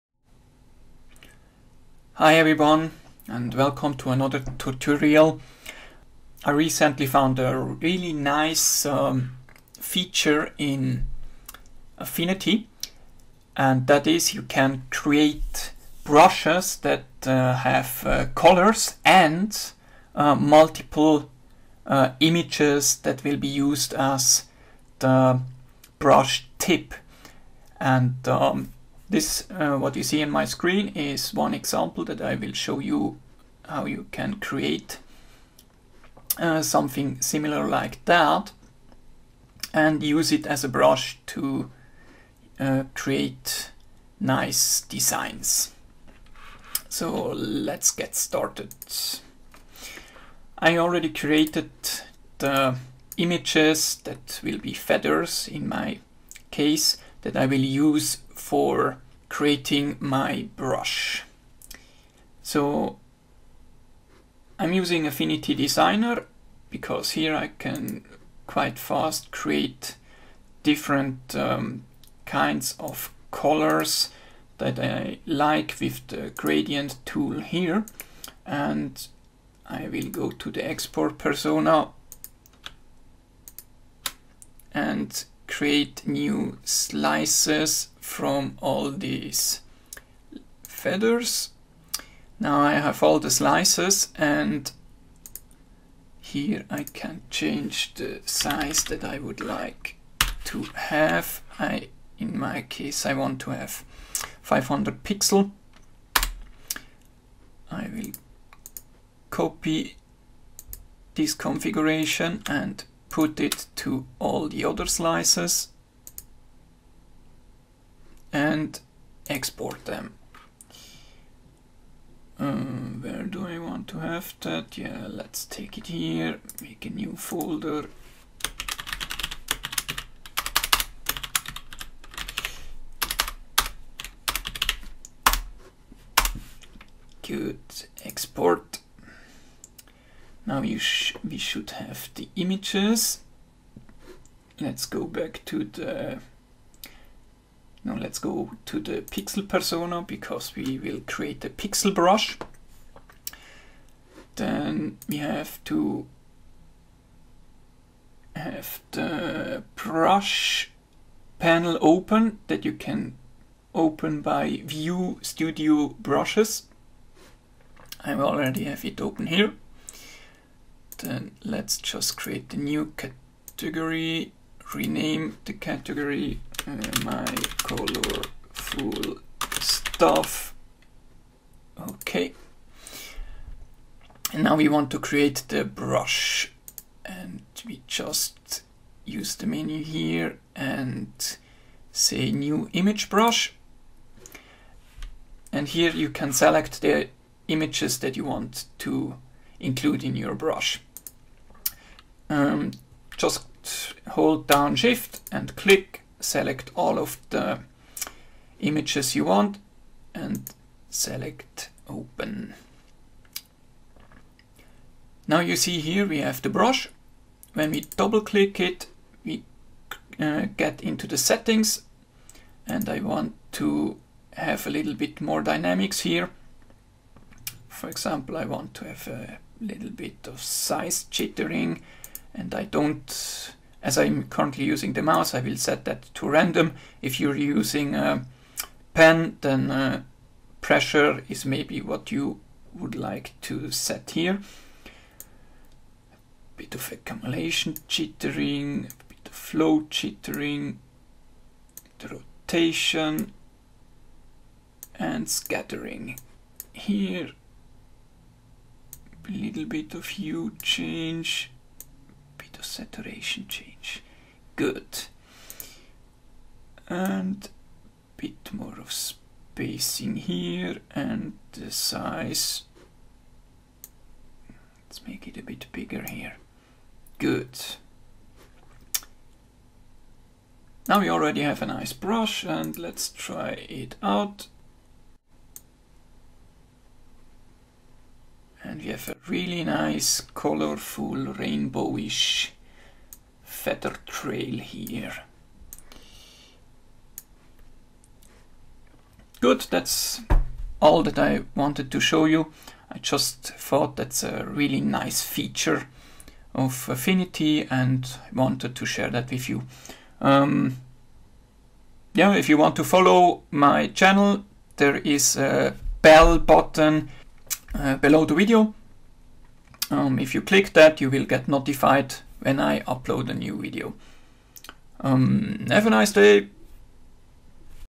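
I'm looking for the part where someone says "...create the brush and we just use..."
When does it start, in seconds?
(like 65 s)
184 s.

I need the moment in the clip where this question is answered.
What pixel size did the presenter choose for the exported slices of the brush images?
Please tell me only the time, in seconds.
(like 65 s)
104 s.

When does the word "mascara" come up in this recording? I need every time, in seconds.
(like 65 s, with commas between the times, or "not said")
not said.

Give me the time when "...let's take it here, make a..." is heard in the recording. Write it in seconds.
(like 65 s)
125 s.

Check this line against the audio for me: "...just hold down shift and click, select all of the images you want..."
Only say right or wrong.
right.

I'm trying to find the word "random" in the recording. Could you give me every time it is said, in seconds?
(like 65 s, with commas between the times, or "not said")
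236 s.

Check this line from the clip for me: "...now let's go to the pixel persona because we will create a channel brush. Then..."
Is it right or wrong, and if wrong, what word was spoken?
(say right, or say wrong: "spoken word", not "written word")
wrong: "pixel", not "channel".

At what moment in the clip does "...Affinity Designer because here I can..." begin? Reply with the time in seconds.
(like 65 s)
65 s.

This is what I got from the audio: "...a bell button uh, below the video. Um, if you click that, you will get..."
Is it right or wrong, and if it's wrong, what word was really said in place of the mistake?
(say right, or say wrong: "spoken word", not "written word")
right.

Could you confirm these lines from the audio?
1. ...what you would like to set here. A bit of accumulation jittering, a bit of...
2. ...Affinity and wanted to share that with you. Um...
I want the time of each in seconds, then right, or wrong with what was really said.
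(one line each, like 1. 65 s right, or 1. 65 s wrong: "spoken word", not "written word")
1. 241 s right
2. 306 s right.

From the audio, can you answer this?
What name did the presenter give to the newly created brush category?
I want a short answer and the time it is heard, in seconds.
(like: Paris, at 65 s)
my colorful stuff, at 177 s.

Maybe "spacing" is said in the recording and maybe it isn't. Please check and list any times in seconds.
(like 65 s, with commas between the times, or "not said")
268 s.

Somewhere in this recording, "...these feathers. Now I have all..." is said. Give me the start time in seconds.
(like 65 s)
88 s.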